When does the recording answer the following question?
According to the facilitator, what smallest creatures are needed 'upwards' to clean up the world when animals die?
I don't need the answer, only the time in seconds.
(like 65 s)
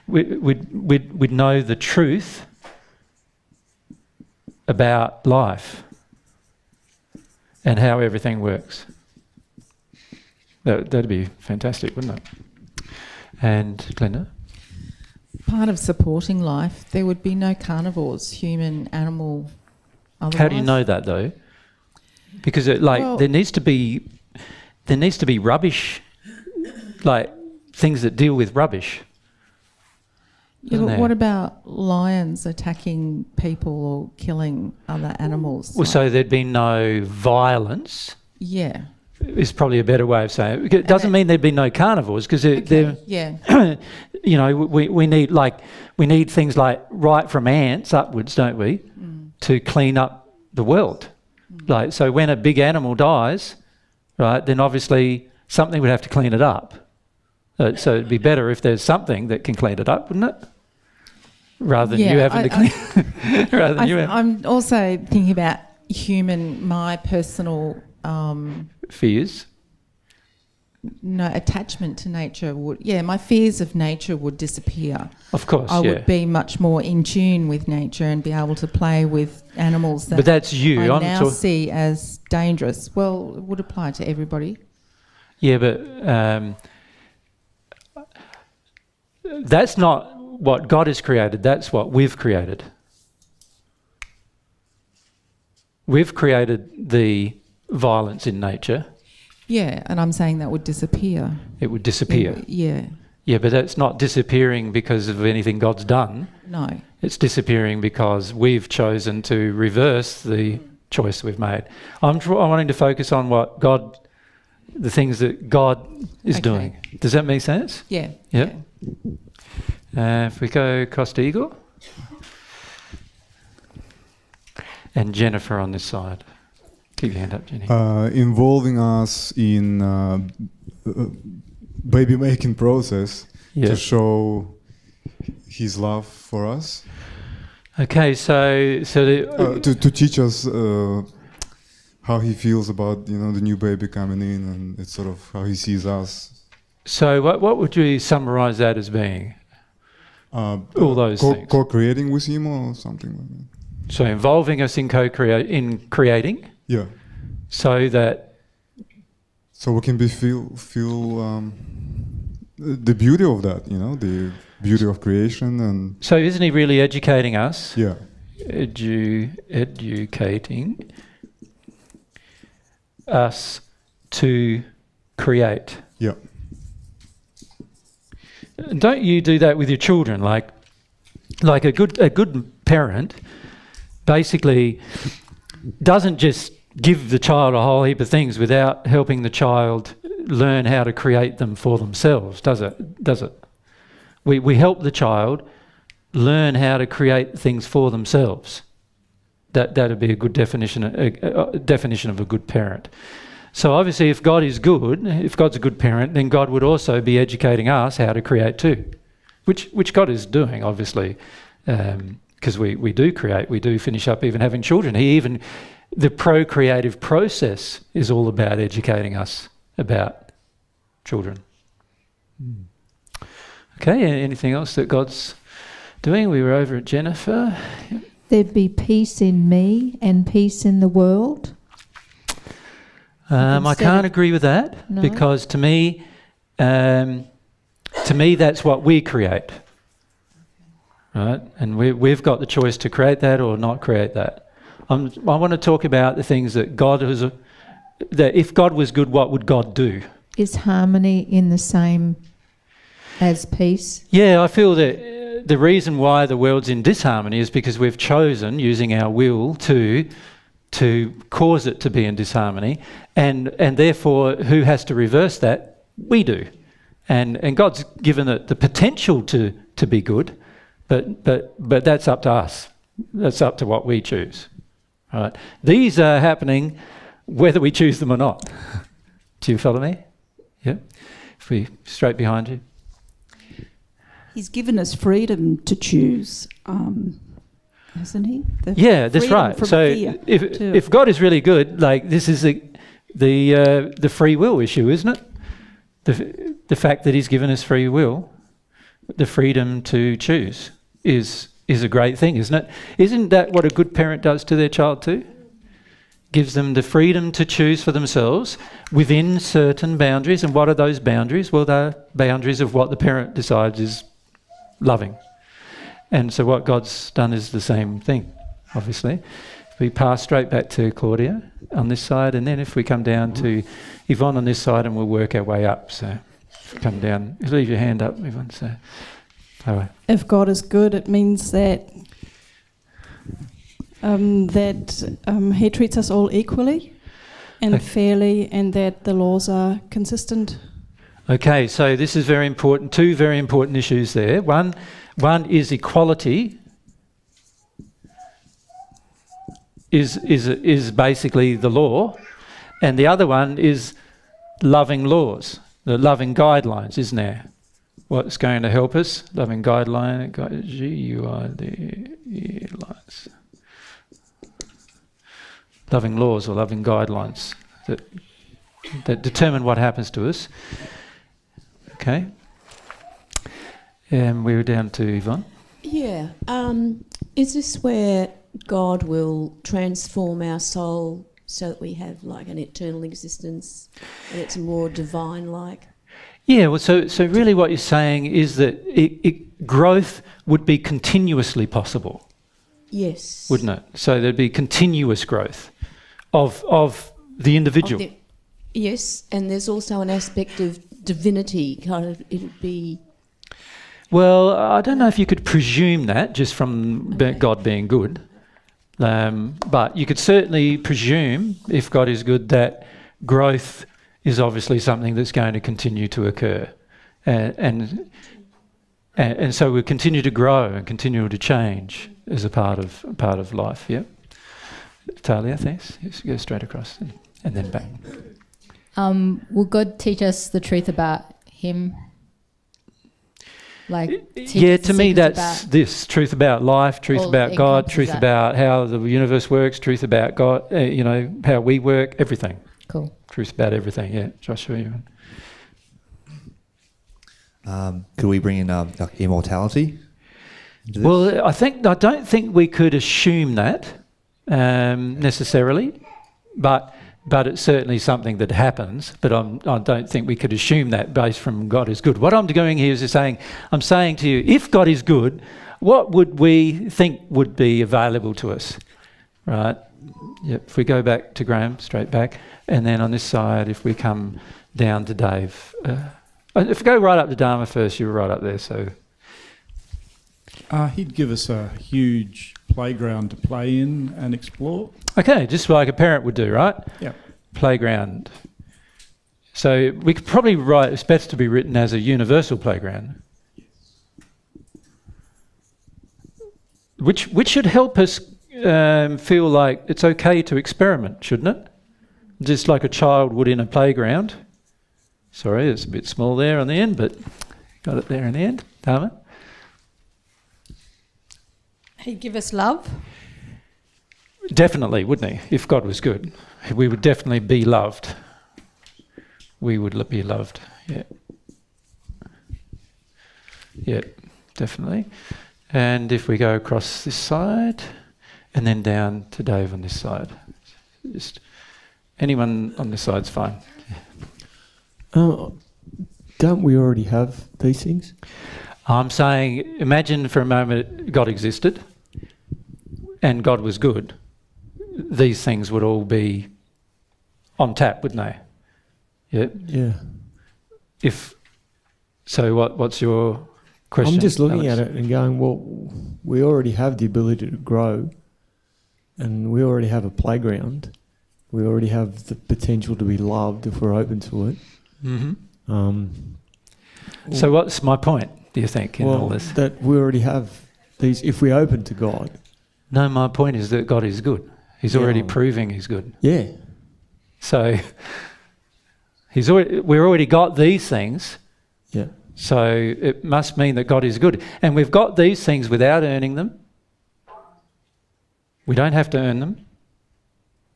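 47 s.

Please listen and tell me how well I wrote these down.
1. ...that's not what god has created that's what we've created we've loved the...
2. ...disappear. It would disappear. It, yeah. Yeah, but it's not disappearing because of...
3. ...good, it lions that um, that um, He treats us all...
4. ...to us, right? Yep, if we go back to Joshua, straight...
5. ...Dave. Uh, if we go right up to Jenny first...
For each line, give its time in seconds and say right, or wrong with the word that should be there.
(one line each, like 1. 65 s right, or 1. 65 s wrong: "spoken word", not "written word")
1. 89 s wrong: "created", not "loved"
2. 100 s right
3. 330 s wrong: "means", not "lions"
4. 468 s wrong: "Graham", not "Joshua"
5. 475 s wrong: "Dharma", not "Jenny".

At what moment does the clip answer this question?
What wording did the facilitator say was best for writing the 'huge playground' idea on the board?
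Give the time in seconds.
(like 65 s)
491 s.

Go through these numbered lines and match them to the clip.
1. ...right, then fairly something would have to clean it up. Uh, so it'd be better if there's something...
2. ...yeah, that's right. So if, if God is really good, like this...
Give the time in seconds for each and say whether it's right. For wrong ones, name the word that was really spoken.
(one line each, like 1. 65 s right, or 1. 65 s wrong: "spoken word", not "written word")
1. 54 s wrong: "obviously", not "fairly"
2. 288 s right.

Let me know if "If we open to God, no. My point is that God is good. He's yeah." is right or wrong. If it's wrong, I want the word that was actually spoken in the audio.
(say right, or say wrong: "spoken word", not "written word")
right.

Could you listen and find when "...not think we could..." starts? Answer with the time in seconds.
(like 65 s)
459 s.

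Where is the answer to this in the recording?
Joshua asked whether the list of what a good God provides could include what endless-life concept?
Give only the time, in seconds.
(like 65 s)
449 s.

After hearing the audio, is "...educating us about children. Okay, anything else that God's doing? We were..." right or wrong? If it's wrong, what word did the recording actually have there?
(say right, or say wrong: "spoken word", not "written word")
right.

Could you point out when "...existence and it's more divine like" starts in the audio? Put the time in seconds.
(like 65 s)
383 s.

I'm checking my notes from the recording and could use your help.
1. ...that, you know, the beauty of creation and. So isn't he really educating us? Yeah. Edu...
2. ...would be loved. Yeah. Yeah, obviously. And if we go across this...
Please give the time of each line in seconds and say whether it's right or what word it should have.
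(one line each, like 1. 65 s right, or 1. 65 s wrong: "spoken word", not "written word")
1. 163 s right
2. 519 s wrong: "definitely", not "obviously".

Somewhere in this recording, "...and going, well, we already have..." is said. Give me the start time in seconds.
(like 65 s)
554 s.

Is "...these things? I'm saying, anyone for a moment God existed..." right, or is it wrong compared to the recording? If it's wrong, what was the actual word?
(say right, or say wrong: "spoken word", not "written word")
wrong: "imagine", not "anyone".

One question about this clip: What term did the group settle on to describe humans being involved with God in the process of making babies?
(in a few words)
co-creating.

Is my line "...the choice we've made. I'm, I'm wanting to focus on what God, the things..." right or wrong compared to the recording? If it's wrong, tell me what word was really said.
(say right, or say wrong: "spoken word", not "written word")
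right.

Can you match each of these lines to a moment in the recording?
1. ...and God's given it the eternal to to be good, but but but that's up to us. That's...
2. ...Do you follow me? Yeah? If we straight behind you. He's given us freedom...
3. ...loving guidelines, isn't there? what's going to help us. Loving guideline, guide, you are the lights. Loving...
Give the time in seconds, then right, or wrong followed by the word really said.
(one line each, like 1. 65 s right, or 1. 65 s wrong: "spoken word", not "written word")
1. 267 s wrong: "potential", not "eternal"
2. 279 s right
3. 355 s right.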